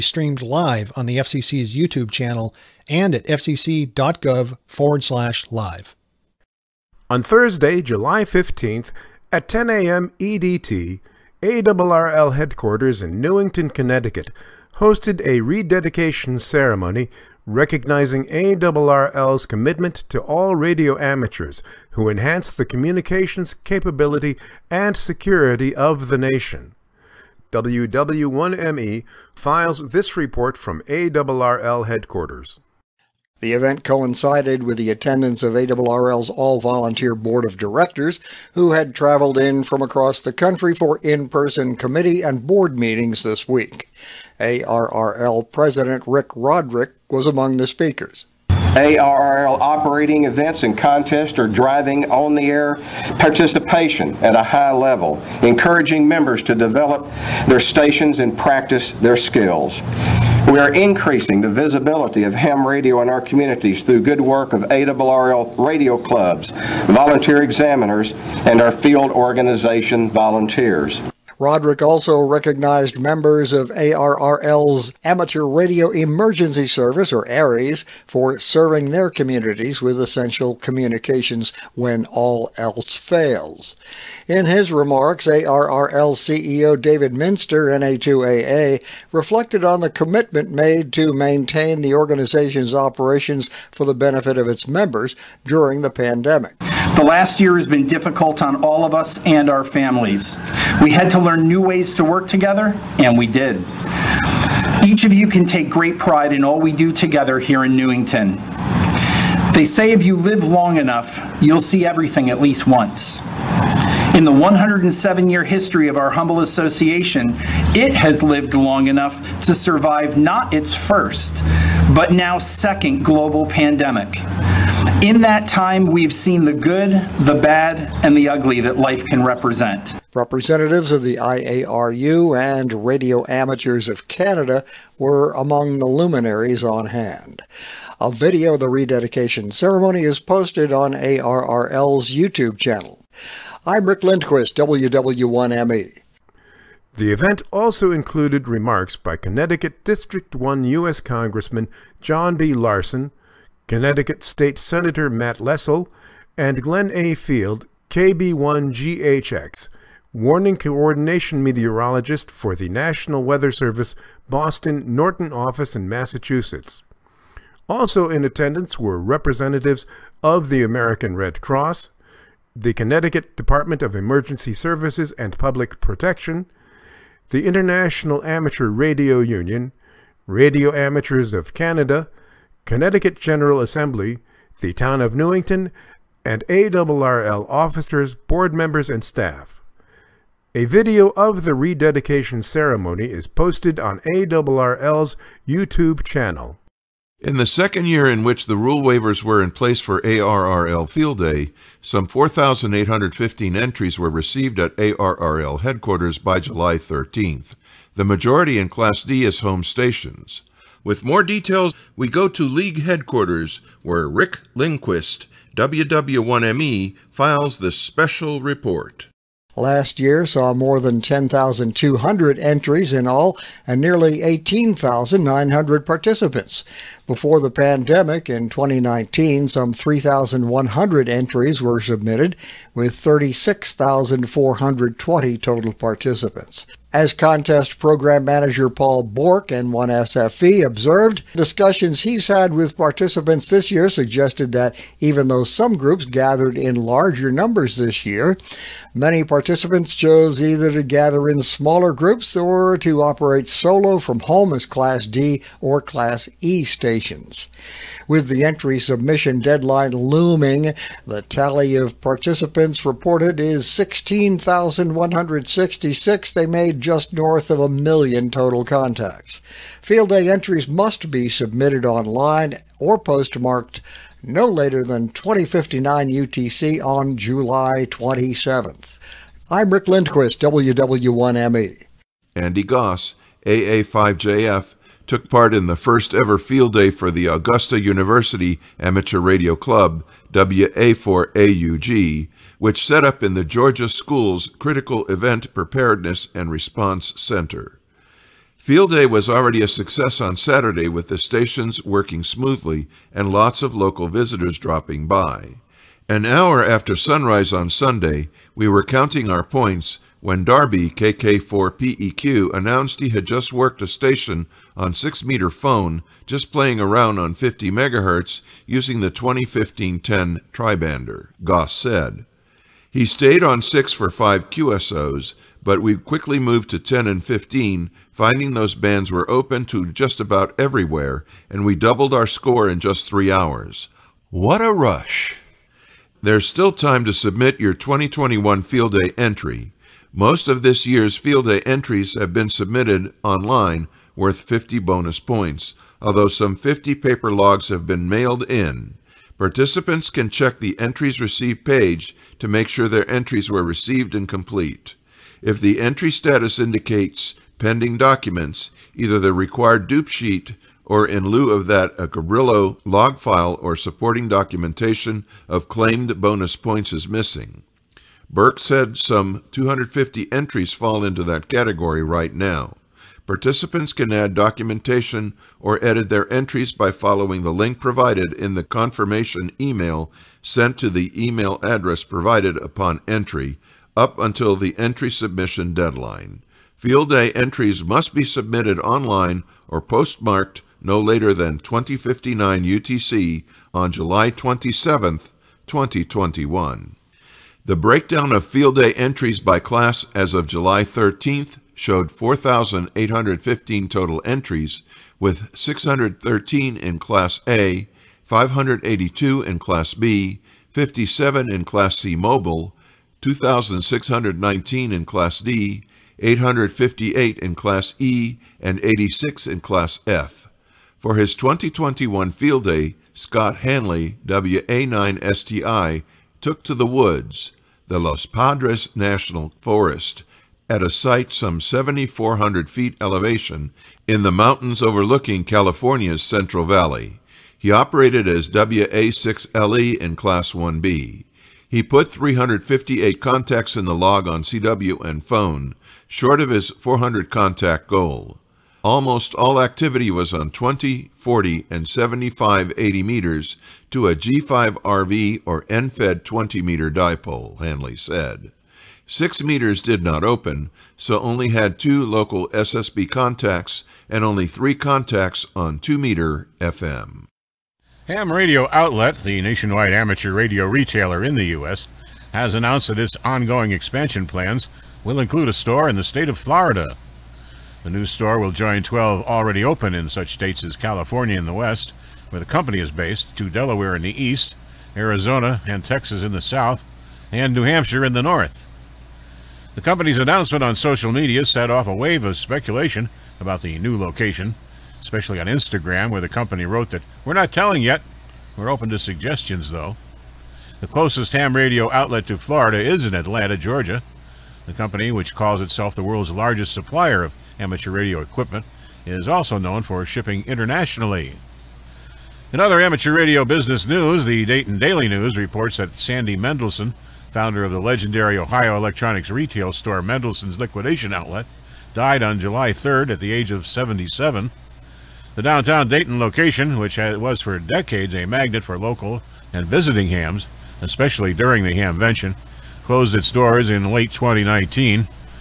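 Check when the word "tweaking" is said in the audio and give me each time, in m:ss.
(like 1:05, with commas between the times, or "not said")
not said.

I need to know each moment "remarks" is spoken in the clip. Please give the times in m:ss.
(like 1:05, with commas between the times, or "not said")
1:24, 2:28.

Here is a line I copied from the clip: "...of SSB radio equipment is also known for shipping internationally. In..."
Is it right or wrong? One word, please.
wrong.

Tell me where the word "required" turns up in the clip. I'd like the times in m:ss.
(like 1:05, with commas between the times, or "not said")
5:59.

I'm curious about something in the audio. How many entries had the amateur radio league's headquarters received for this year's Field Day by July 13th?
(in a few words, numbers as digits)
4,815.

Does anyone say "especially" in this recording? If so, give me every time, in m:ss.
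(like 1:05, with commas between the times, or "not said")
8:15, 8:50.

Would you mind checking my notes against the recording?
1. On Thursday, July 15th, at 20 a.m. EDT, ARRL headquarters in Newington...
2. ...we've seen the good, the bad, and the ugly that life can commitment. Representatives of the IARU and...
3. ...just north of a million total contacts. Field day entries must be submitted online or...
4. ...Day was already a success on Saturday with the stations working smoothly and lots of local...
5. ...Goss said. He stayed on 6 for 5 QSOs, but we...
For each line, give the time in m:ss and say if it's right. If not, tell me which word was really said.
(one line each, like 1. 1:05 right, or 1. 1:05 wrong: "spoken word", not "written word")
1. 0:07 wrong: "10", not "20"
2. 2:05 wrong: "represent", not "commitment"
3. 4:26 right
4. 4:58 right
5. 5:21 right.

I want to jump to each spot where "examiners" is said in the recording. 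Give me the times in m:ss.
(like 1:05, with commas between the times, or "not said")
1:07.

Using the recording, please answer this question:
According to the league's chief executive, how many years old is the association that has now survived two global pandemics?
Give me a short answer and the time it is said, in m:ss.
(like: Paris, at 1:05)
107, at 1:54.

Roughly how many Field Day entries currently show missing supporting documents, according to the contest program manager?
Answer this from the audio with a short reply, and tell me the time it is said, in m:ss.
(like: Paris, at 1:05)
250, at 6:09.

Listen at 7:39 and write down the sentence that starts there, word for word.
Six meters did not open, so only had two local SSB contacts and only three contacts on 2 meter FM.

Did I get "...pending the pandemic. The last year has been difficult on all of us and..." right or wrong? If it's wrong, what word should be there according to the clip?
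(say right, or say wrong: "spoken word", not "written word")
wrong: "during", not "pending".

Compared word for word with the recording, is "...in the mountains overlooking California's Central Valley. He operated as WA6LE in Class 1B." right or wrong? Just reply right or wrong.
right.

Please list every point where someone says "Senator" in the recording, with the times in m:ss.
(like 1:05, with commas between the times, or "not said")
2:34.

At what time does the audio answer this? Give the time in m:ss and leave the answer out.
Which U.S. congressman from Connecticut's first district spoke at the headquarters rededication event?
2:32.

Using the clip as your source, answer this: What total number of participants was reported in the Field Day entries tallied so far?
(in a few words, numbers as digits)
16,166.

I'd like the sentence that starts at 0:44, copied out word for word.
ARRL President Rick Roderick was among the speakers.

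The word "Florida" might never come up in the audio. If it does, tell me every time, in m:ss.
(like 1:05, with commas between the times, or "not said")
7:56, 8:22.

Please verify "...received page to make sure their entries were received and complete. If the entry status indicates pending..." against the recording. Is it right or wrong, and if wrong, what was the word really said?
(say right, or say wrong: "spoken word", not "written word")
right.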